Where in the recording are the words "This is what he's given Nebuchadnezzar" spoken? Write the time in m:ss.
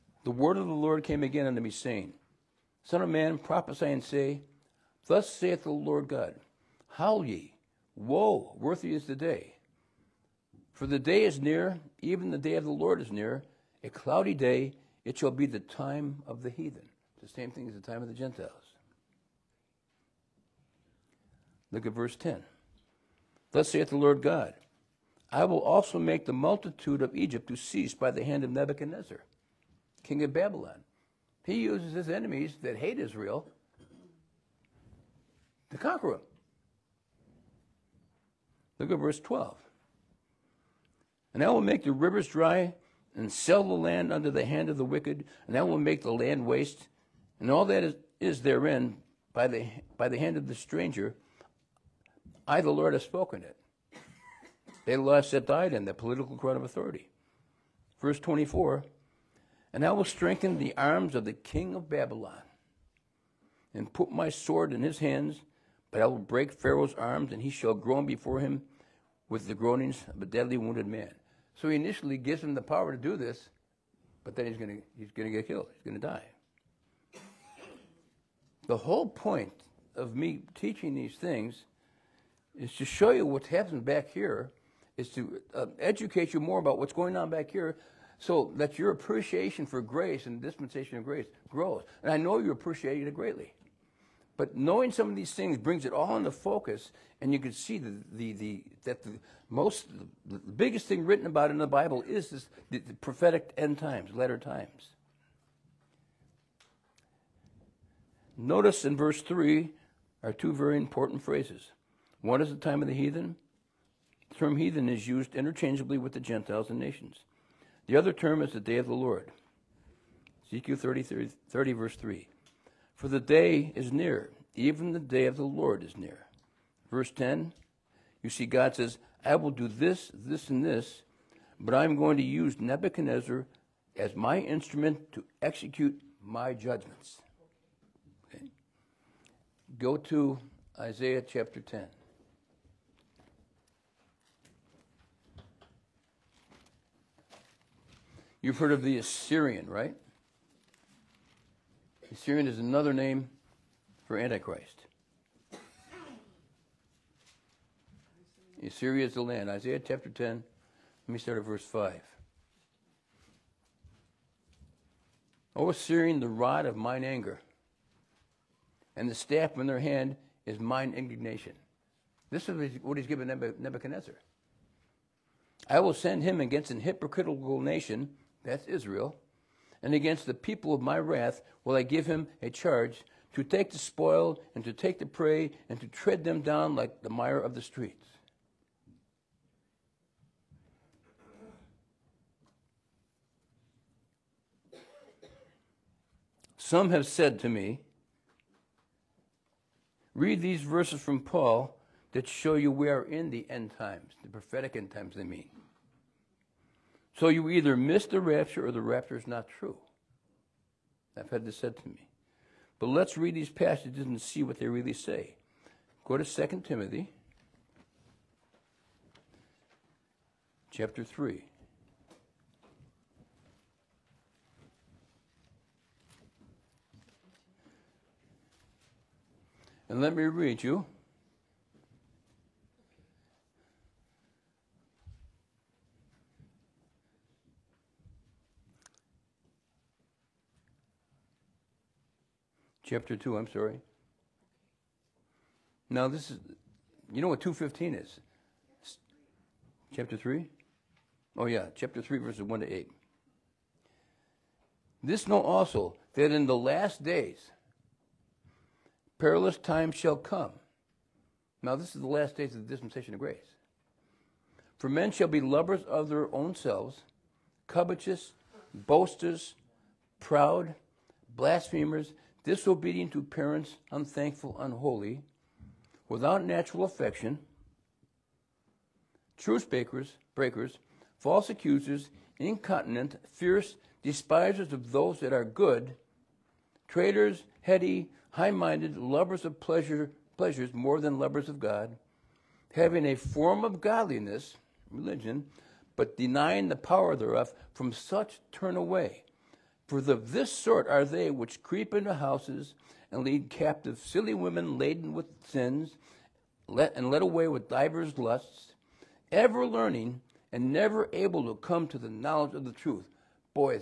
2:52.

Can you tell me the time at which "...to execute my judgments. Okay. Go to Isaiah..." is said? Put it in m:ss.
2:15.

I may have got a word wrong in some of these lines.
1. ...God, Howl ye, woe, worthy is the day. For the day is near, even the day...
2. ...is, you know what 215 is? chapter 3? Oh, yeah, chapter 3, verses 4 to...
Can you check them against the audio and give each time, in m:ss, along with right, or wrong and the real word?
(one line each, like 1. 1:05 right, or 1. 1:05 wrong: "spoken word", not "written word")
1. 0:06 right
2. 4:06 wrong: "1", not "4".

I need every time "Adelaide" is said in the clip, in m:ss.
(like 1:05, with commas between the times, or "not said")
not said.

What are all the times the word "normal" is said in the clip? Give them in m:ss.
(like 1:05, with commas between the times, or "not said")
not said.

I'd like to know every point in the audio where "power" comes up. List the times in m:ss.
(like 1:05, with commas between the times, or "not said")
1:12, 4:56.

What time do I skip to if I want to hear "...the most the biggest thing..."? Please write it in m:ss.
1:39.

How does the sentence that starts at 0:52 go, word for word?
I, the Lord, have spoken it.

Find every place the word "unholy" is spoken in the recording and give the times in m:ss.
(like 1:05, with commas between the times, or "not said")
4:34.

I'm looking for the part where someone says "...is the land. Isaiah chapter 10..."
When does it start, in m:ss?
2:39.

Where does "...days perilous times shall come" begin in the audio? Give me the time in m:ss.
4:17.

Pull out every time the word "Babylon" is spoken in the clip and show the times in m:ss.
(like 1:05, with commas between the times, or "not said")
0:30, 1:01.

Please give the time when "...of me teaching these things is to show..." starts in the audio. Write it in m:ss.
1:19.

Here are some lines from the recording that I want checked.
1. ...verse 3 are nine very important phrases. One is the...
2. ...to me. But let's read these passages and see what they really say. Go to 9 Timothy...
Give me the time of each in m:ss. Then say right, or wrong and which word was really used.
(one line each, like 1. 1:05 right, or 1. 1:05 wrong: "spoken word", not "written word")
1. 1:48 wrong: "two", not "nine"
2. 3:31 wrong: "2", not "9".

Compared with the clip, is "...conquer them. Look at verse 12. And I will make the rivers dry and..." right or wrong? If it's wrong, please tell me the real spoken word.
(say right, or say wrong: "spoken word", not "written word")
right.